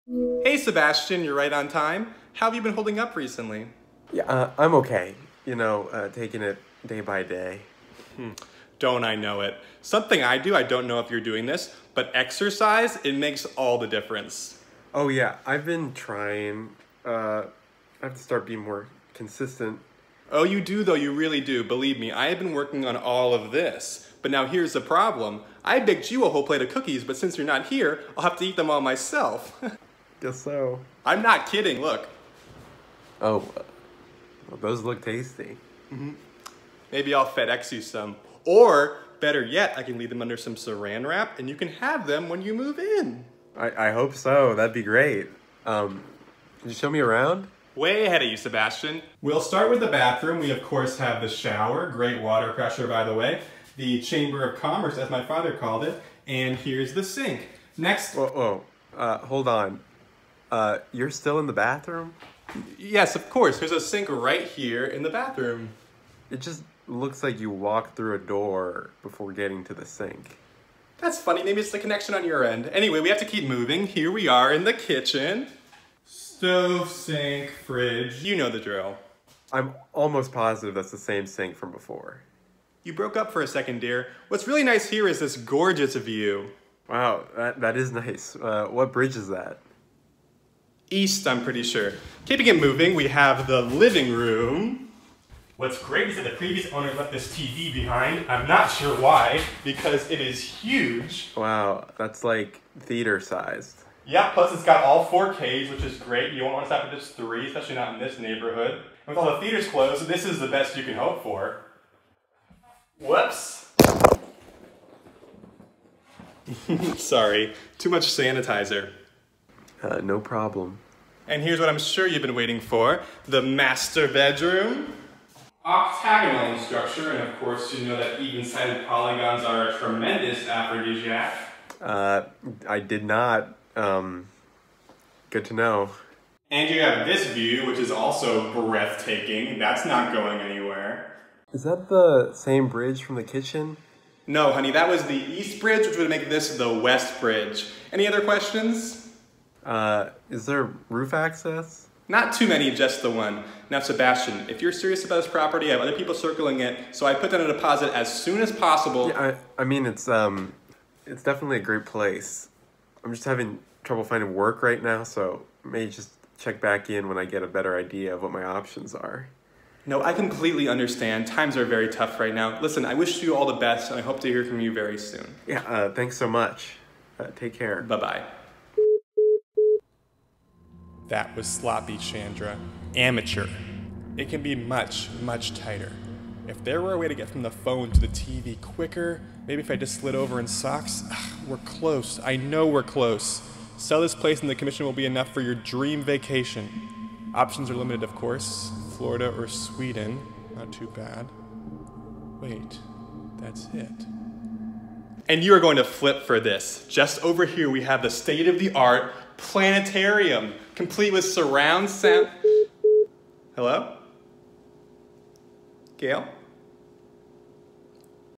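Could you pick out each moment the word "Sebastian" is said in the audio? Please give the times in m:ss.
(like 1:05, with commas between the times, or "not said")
0:00, 0:48, 2:33.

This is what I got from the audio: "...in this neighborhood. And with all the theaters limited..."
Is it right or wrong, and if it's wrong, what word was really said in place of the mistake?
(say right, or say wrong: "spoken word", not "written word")
wrong: "closed", not "limited".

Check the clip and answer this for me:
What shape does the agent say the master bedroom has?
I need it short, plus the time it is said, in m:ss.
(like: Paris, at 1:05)
Octagonal, at 2:05.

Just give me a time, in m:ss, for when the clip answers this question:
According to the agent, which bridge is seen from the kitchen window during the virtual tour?
2:25.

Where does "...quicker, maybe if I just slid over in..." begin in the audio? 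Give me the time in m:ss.
3:08.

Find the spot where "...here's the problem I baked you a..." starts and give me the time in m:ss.
0:24.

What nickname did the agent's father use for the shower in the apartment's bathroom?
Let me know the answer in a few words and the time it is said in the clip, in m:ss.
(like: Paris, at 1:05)
The Chamber of Commerce, at 0:53.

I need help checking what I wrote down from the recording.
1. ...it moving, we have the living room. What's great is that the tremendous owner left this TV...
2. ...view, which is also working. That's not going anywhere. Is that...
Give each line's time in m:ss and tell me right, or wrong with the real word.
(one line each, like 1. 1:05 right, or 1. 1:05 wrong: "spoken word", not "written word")
1. 1:32 wrong: "previous", not "tremendous"
2. 2:17 wrong: "breathtaking", not "working".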